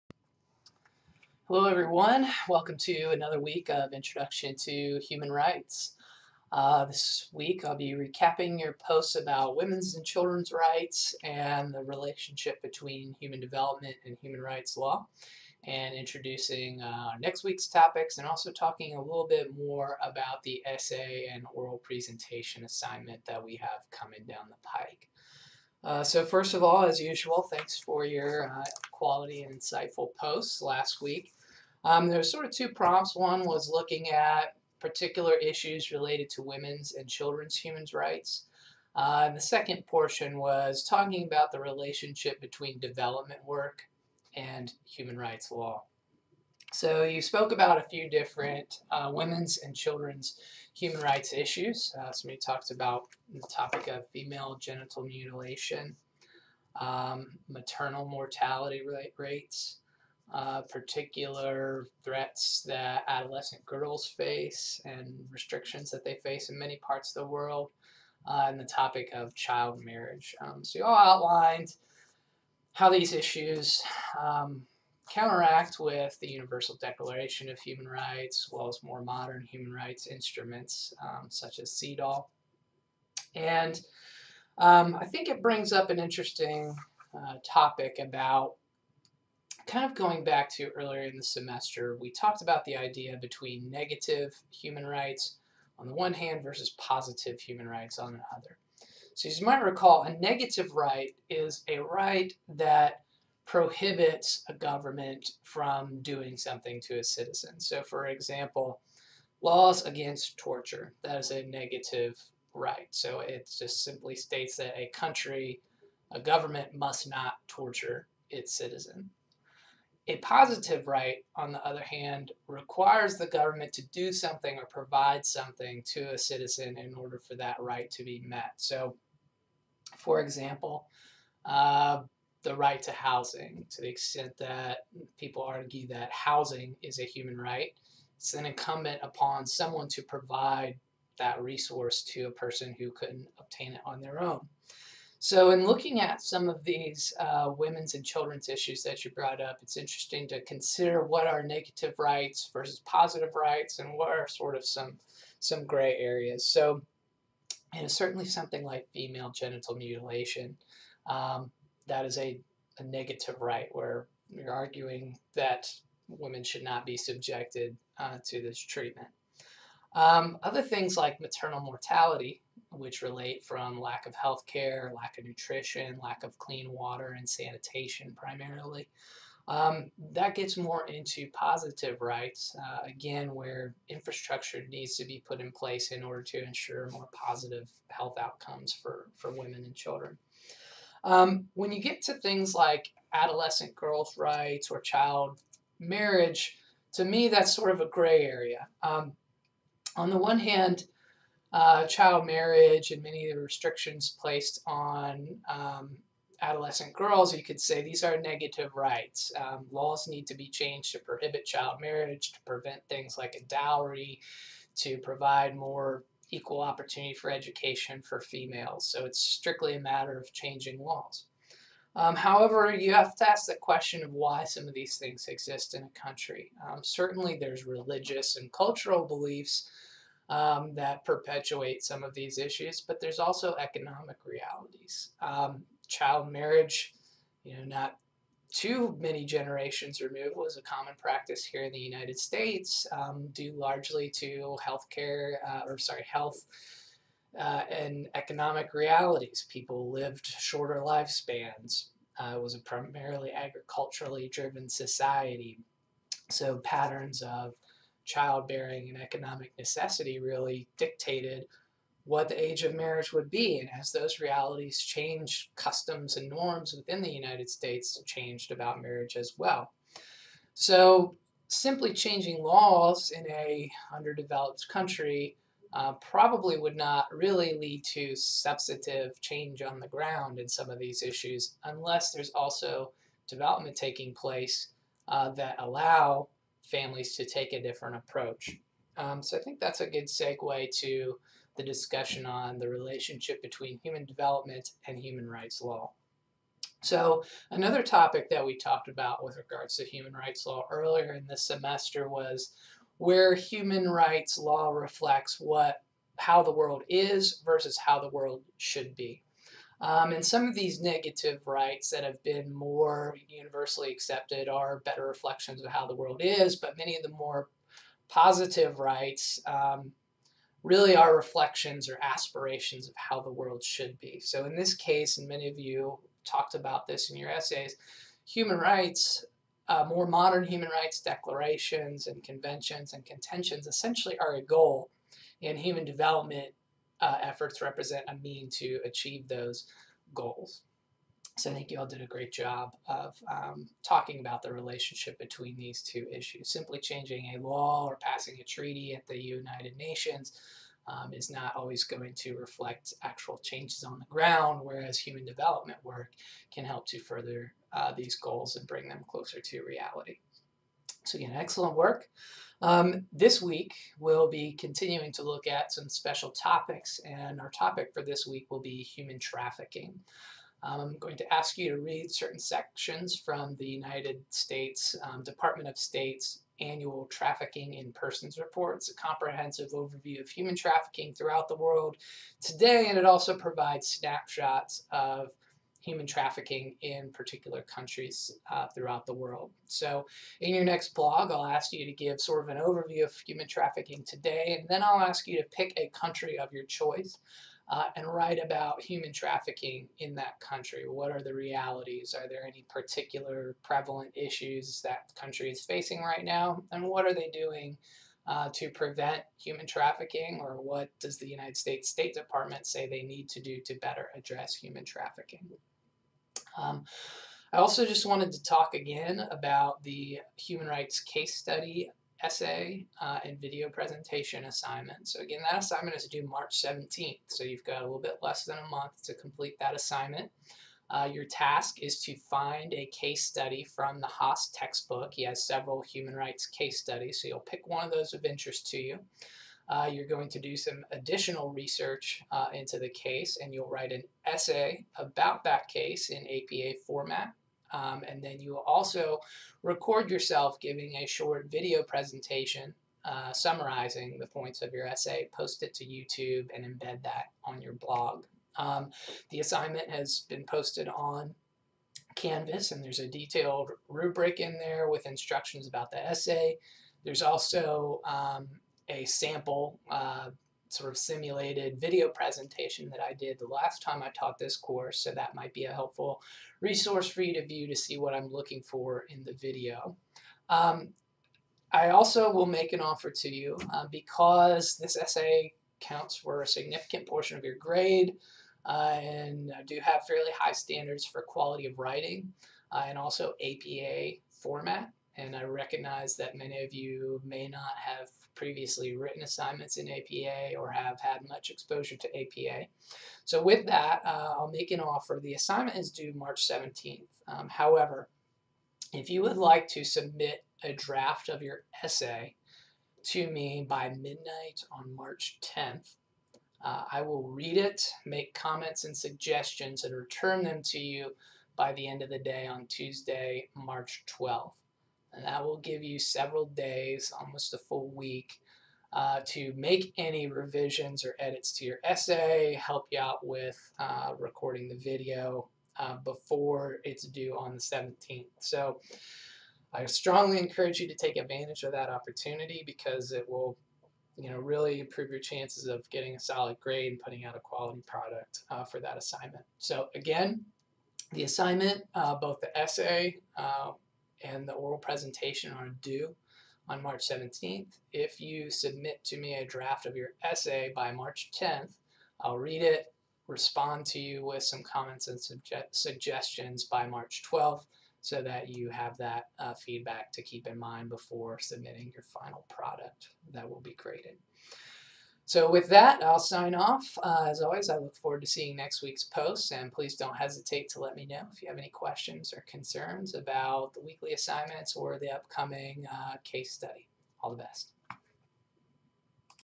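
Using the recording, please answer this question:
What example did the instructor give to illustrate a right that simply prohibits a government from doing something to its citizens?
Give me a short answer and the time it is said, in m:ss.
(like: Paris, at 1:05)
laws against torture, at 1:49.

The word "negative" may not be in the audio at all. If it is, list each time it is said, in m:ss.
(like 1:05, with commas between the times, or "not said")
1:33, 1:40, 1:51, 2:31, 2:42, 3:28, 5:10.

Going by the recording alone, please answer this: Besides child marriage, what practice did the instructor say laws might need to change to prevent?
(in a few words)
dowry.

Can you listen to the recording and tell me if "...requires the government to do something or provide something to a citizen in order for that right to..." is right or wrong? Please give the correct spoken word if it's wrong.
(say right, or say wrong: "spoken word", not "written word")
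right.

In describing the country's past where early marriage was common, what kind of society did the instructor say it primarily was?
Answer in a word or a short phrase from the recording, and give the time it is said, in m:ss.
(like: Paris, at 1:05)
agriculturally driven, at 4:13.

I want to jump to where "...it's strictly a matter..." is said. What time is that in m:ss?
3:39.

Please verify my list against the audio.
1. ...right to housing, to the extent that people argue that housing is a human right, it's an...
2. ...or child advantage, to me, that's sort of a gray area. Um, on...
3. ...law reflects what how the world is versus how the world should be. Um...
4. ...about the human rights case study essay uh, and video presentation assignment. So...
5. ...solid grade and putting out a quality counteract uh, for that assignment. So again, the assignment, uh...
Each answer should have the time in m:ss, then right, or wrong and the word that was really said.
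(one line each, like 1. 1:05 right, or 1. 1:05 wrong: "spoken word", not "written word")
1. 2:12 right
2. 3:14 wrong: "marriage", not "advantage"
3. 5:04 right
4. 6:59 right
5. 9:06 wrong: "product", not "counteract".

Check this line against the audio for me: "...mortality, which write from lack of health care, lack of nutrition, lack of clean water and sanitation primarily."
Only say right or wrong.
wrong.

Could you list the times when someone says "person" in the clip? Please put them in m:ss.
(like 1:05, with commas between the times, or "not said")
2:22, 6:17.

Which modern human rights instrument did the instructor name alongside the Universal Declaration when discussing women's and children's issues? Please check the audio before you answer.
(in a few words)
CEDAW.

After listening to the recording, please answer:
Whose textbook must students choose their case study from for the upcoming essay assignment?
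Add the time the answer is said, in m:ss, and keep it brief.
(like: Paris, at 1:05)
Haas, at 7:14.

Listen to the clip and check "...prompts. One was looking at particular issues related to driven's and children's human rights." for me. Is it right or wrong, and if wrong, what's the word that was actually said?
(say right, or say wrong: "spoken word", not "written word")
wrong: "women", not "driven".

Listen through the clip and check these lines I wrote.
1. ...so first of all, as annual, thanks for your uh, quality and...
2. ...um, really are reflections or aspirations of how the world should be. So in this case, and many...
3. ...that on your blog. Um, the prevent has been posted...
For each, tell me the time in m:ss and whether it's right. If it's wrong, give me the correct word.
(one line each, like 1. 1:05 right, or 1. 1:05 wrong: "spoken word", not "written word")
1. 0:26 wrong: "usual", not "annual"
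2. 5:19 right
3. 7:37 wrong: "assignment", not "prevent".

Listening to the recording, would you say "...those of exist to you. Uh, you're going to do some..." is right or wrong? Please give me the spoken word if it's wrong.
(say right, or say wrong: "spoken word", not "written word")
wrong: "interest", not "exist".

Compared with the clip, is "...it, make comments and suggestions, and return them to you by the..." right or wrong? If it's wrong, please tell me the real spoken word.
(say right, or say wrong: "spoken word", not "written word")
right.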